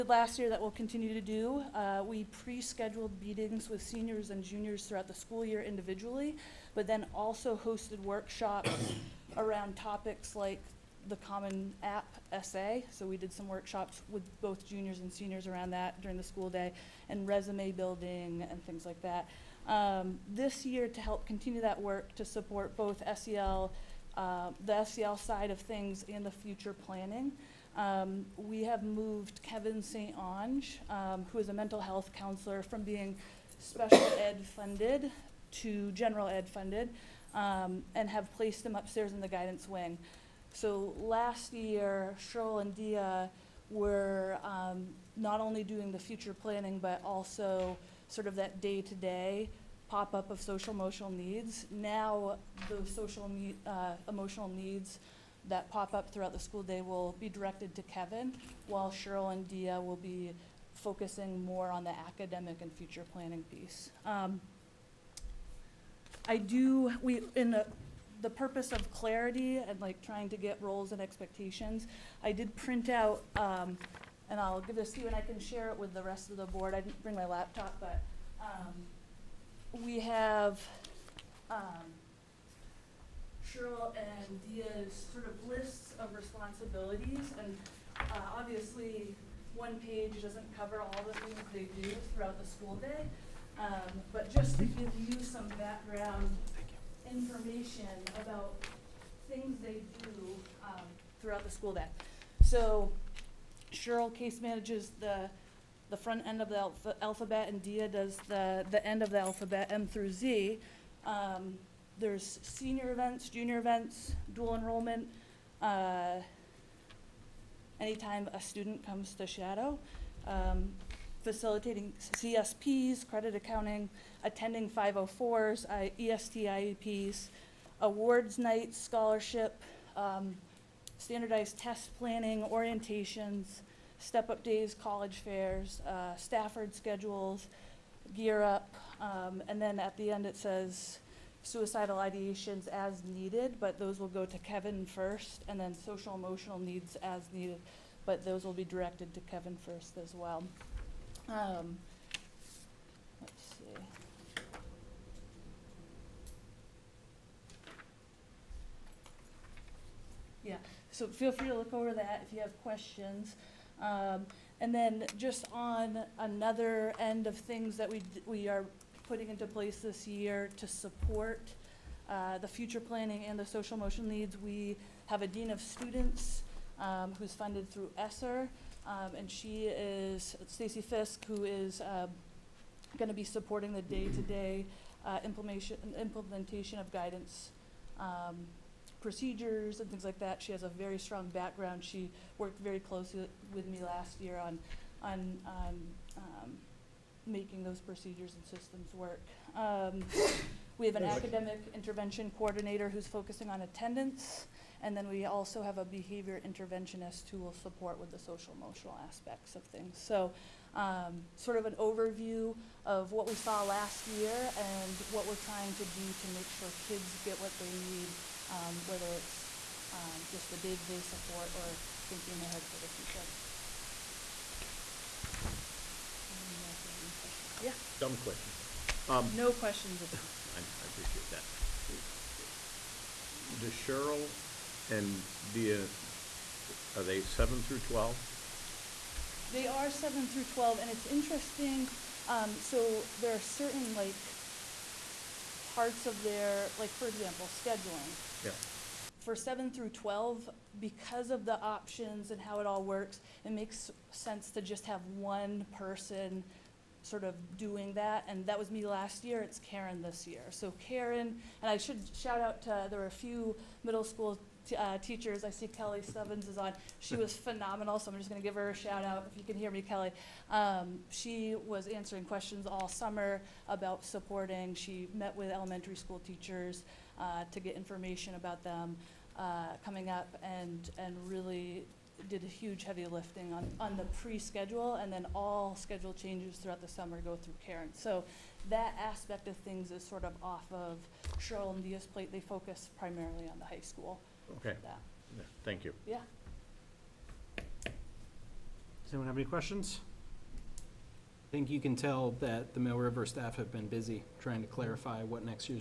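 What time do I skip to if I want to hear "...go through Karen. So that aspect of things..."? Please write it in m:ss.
4:47.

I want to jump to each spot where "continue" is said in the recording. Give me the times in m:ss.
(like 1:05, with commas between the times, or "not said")
0:00, 0:21.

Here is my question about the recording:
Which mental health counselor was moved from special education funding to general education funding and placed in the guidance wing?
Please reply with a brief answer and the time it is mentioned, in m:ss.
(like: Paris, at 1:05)
Kevin St. Ange, at 0:29.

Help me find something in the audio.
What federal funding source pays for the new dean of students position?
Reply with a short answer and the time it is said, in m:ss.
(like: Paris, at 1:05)
ESSER, at 2:57.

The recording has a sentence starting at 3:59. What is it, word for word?
They are seven through twelve, and it's interesting, um, so there are certain like parts of their, like, for example, scheduling.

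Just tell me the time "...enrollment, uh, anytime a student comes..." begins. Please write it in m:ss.
1:54.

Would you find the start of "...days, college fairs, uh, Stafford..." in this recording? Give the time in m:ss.
2:14.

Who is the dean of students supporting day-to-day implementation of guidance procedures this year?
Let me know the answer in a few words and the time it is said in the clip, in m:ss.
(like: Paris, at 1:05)
Stacy Fisk, at 3:00.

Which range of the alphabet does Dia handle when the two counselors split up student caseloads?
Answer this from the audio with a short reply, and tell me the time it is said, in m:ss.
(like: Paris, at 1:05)
M through Z, at 1:49.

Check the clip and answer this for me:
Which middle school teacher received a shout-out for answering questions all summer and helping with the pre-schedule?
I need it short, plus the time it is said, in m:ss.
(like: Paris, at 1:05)
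Kelly Stubbins, at 4:25.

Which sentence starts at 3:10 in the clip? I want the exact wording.
She has a very strong background.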